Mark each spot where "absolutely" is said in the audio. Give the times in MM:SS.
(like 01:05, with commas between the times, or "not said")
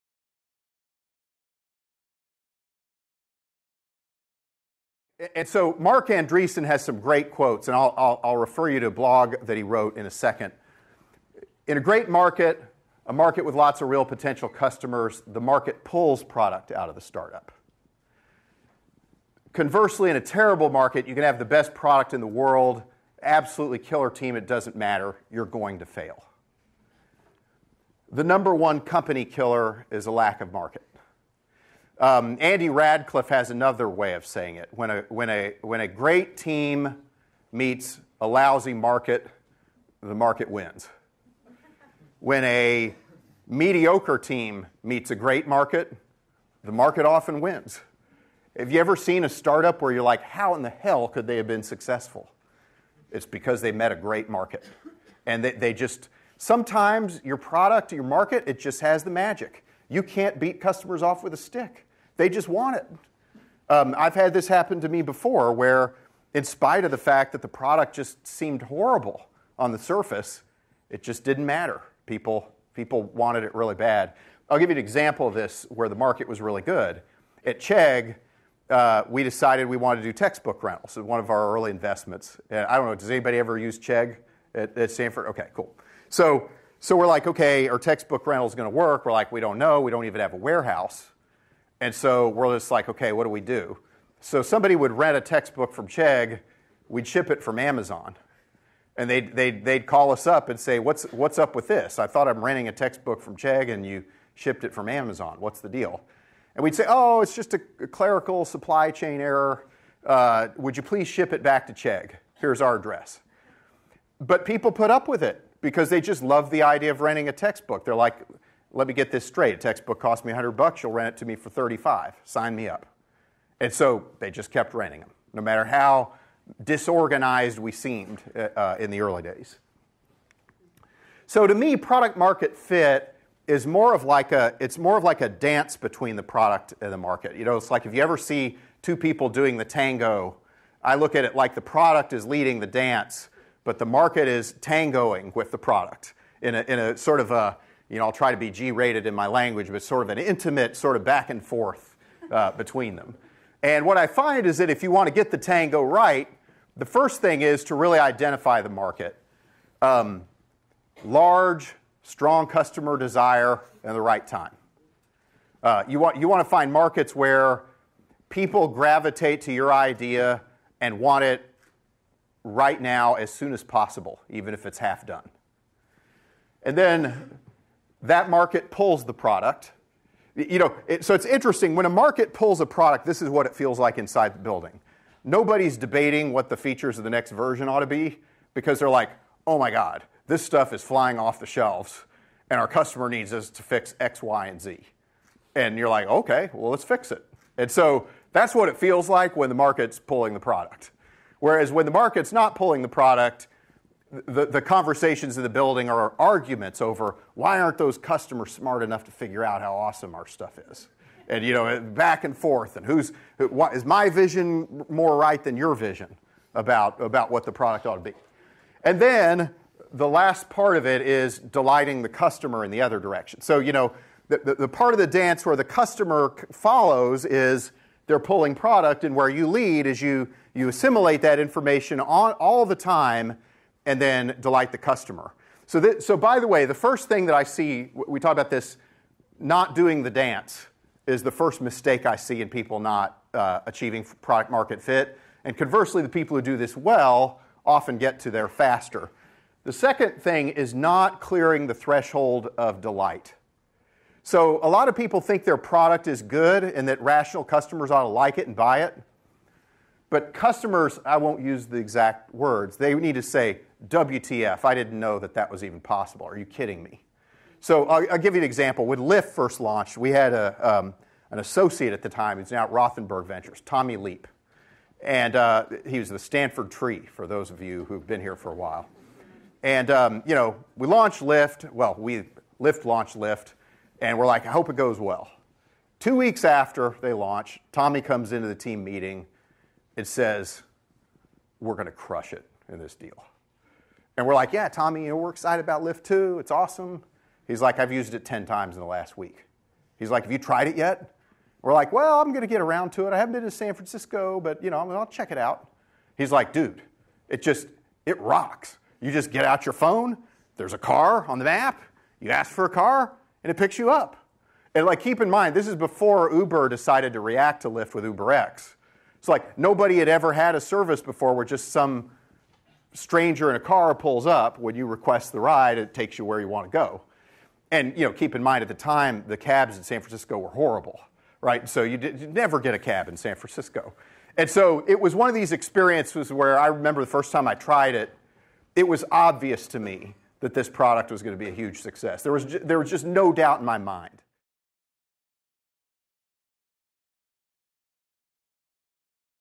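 00:23.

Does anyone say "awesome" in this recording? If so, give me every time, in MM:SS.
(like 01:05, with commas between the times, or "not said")
03:29, 04:56.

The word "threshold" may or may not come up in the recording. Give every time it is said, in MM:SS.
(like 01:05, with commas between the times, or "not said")
04:11.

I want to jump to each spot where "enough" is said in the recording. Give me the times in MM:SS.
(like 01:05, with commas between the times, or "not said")
03:28.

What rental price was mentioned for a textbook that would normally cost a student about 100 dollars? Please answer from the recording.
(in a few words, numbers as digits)
35.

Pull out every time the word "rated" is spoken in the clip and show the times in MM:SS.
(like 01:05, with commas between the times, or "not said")
02:28.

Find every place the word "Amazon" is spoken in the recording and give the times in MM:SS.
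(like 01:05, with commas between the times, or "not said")
01:37, 01:44.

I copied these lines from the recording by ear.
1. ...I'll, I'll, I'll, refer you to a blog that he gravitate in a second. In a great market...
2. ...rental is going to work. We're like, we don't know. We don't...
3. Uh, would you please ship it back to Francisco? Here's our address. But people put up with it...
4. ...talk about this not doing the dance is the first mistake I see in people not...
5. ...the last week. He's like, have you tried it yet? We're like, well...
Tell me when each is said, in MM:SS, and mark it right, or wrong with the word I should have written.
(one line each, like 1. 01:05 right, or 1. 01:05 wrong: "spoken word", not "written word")
1. 00:07 wrong: "wrote", not "gravitate"
2. 01:28 right
3. 01:50 wrong: "Chegg", not "Francisco"
4. 03:58 right
5. 04:58 right.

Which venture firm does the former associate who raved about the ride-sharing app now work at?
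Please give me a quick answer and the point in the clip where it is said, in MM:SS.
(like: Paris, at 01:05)
Rothenberg Ventures, at 04:32.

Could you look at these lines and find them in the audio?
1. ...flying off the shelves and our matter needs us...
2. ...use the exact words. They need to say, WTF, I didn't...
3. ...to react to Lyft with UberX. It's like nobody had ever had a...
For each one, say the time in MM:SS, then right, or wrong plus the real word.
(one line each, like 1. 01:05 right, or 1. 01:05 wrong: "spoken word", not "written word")
1. 03:10 wrong: "customer", not "matter"
2. 04:21 right
3. 05:17 right.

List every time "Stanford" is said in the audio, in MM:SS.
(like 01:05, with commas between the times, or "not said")
01:24, 04:36.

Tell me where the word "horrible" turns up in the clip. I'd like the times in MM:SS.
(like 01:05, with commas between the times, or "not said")
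01:08, 05:30.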